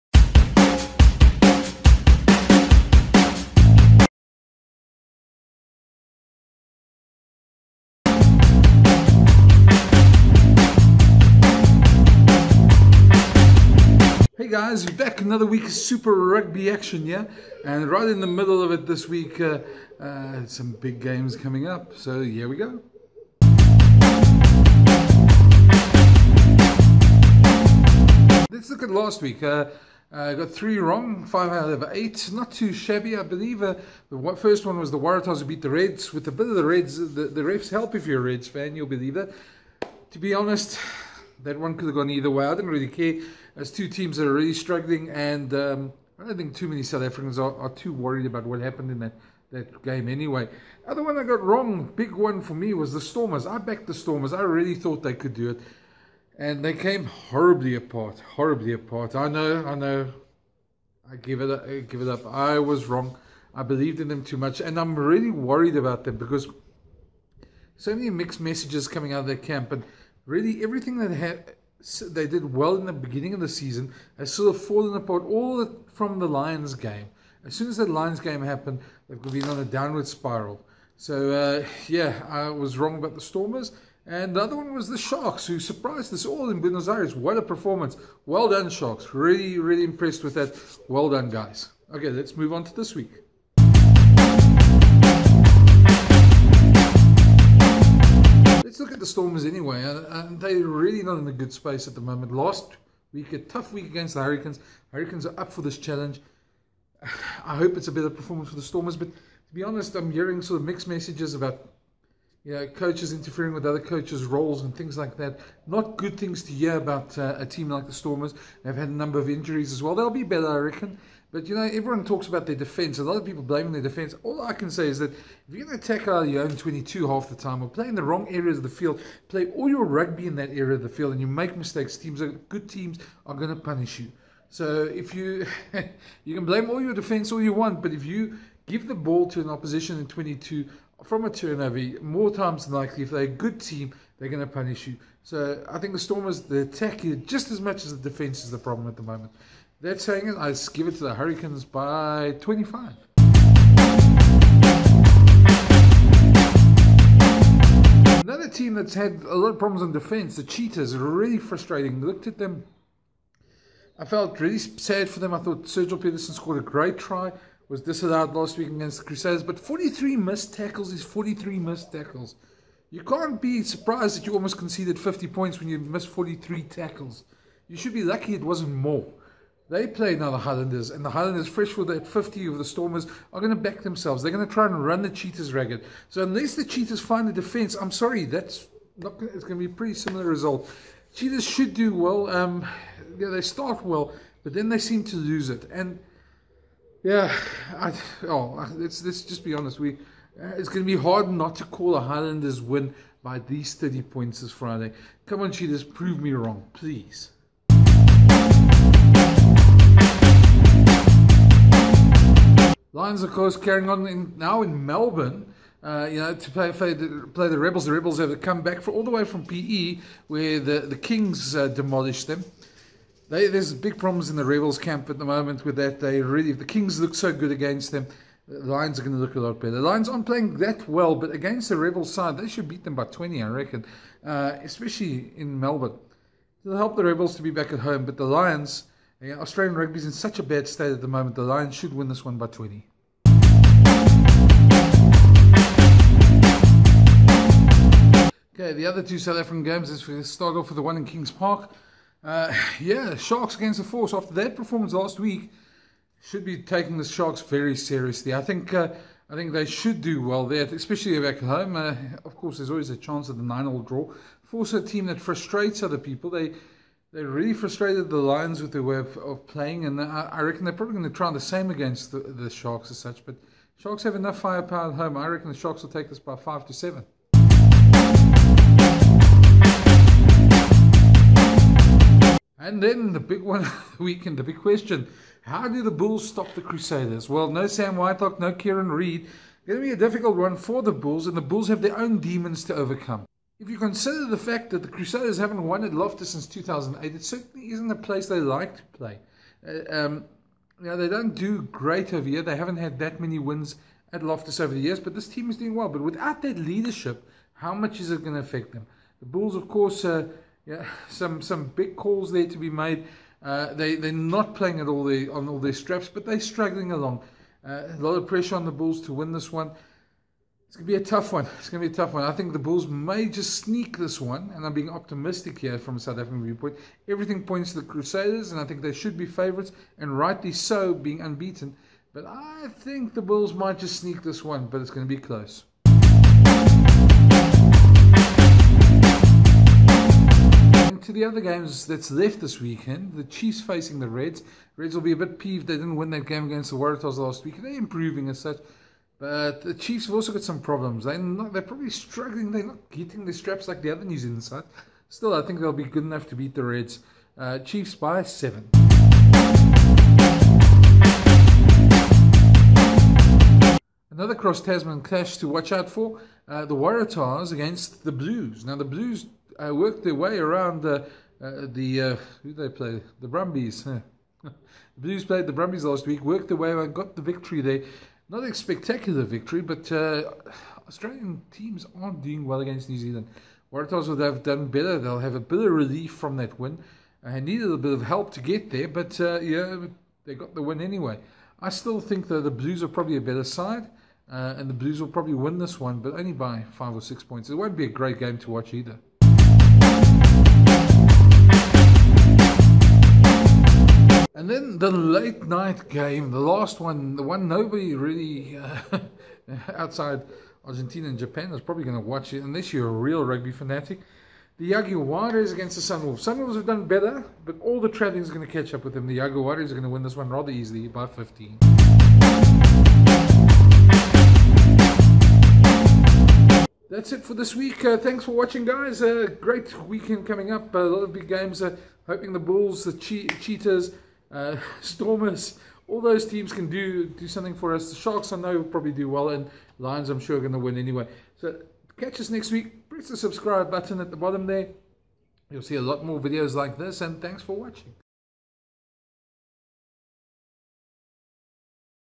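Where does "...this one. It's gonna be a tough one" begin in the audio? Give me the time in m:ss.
5:19.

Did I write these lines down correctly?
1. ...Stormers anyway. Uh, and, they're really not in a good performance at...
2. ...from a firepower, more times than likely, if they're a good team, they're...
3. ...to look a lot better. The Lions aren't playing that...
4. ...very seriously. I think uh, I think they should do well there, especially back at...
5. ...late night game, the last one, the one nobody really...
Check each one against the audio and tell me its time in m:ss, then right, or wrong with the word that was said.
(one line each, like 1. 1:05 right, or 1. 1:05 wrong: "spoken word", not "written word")
1. 1:39 wrong: "space", not "performance"
2. 2:21 wrong: "turnover", not "firepower"
3. 3:49 right
4. 4:17 right
5. 6:44 right.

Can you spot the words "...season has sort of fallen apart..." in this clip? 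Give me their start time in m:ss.
1:13.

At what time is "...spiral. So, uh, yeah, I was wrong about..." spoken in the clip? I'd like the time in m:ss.
1:20.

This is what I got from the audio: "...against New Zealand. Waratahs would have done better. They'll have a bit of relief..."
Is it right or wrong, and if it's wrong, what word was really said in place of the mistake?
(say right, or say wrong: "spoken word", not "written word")
right.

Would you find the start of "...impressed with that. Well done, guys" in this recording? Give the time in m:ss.
1:29.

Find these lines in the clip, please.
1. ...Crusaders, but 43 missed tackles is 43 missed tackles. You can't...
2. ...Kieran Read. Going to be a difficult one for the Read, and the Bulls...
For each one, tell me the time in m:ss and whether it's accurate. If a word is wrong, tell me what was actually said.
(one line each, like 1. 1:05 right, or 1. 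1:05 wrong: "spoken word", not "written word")
1. 2:49 right
2. 4:48 wrong: "Bulls", not "Read".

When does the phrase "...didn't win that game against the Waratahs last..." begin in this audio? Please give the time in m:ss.
5:45.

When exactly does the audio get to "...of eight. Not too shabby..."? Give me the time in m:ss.
0:31.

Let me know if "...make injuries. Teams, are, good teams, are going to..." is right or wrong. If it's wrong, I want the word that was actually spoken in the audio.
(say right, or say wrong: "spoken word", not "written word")
wrong: "mistakes", not "injuries".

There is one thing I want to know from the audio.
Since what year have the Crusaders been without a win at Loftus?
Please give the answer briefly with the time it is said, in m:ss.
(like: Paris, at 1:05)
2008, at 4:56.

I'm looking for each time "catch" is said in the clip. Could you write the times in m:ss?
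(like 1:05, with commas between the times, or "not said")
6:58, 7:21.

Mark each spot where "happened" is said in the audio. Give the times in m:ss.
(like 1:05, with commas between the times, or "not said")
0:48, 1:18.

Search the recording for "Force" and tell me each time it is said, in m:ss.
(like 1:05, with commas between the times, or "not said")
4:13, 4:24.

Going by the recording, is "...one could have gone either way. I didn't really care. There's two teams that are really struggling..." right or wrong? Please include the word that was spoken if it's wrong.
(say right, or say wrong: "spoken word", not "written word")
right.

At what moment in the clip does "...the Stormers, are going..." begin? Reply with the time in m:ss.
3:02.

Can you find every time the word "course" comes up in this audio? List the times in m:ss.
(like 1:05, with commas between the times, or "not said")
3:33, 4:22, 5:09.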